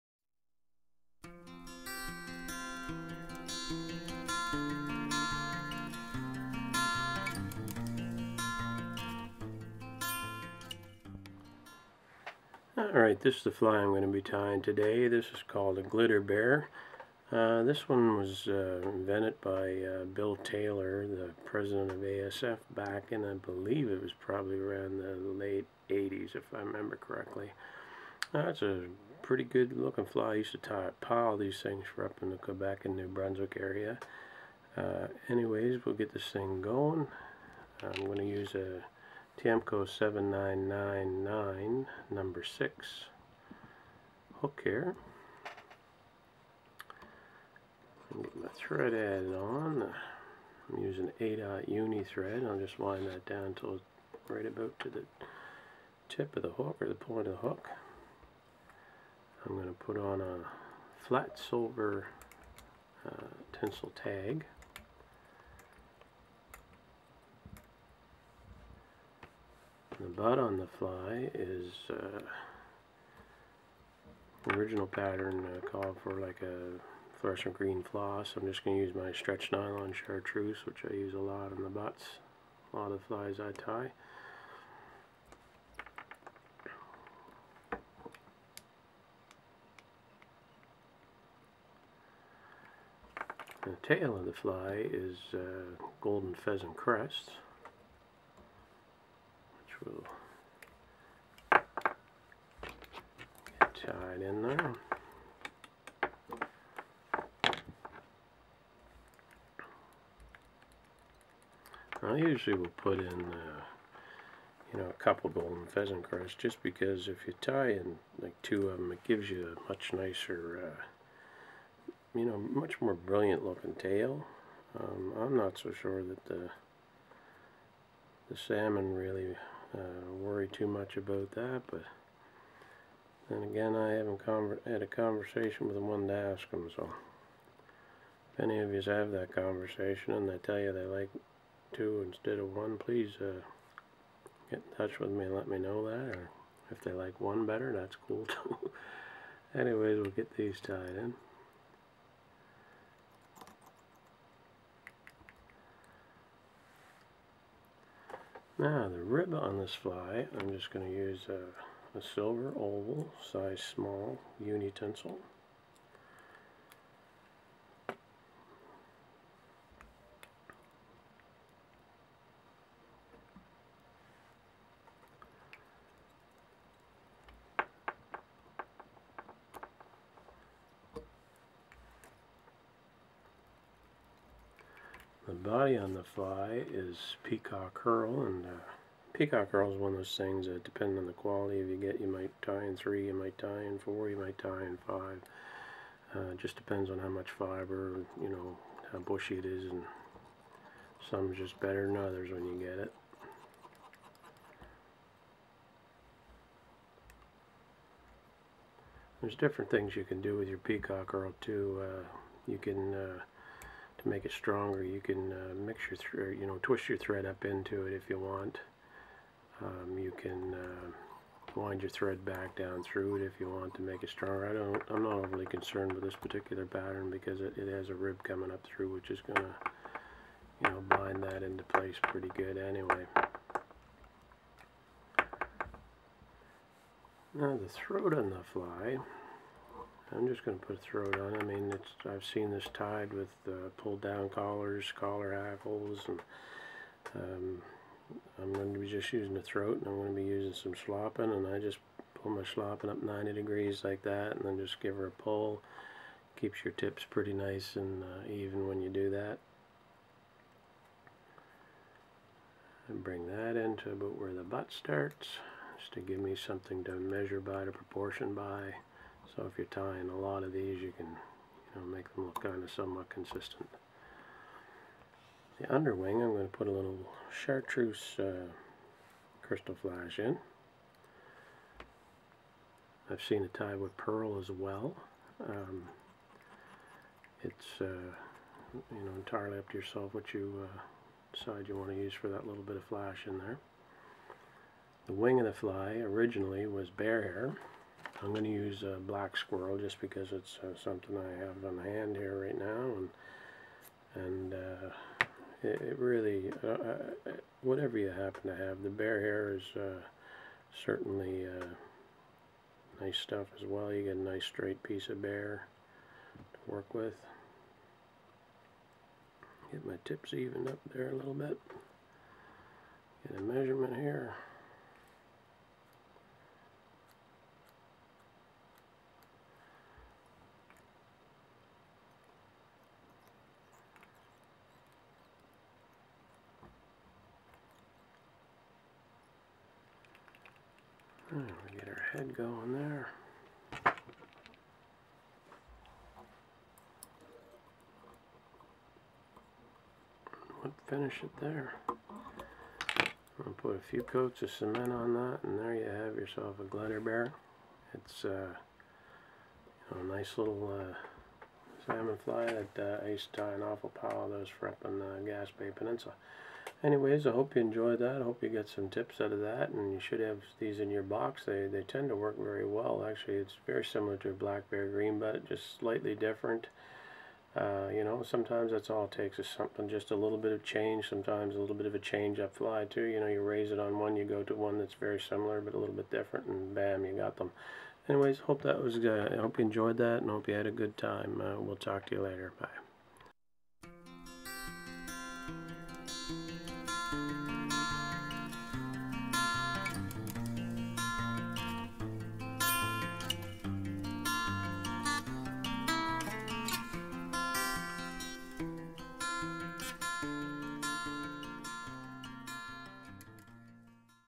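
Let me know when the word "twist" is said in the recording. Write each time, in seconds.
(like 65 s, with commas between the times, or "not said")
216 s.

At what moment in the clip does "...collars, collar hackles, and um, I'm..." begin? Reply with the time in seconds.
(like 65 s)
244 s.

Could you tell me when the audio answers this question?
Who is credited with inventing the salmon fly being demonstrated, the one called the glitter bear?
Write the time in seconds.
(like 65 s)
20 s.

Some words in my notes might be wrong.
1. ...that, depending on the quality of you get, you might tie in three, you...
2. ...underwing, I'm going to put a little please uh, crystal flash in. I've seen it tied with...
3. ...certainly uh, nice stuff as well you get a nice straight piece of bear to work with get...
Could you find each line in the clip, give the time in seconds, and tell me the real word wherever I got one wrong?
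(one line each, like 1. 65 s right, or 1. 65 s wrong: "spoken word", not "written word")
1. 190 s right
2. 275 s wrong: "chartreuse", not "please"
3. 310 s right.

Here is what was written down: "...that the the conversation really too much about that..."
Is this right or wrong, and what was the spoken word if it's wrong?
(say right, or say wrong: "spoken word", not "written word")
wrong: "salmon", not "conversation".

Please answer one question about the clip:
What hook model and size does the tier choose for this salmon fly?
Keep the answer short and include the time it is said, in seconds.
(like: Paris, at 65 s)
Tiemco 7999 number 6, at 39 s.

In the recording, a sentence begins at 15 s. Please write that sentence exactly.
This is called a glitter bear.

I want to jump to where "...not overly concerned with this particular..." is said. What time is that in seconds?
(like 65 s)
225 s.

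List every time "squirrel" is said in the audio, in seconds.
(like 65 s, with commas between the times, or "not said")
299 s.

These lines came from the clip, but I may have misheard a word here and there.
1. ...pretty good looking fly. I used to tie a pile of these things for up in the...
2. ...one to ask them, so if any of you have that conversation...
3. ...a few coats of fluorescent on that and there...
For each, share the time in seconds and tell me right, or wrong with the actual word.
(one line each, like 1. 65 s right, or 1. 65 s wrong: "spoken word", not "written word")
1. 29 s right
2. 135 s right
3. 353 s wrong: "cement", not "fluorescent".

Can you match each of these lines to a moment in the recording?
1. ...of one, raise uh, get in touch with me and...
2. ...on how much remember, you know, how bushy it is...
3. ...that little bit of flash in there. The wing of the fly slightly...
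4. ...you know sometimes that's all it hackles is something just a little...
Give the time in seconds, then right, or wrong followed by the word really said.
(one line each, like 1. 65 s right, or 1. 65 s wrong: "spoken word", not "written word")
1. 142 s wrong: "please", not "raise"
2. 196 s wrong: "fiber", not "remember"
3. 292 s wrong: "originally", not "slightly"
4. 377 s wrong: "takes", not "hackles".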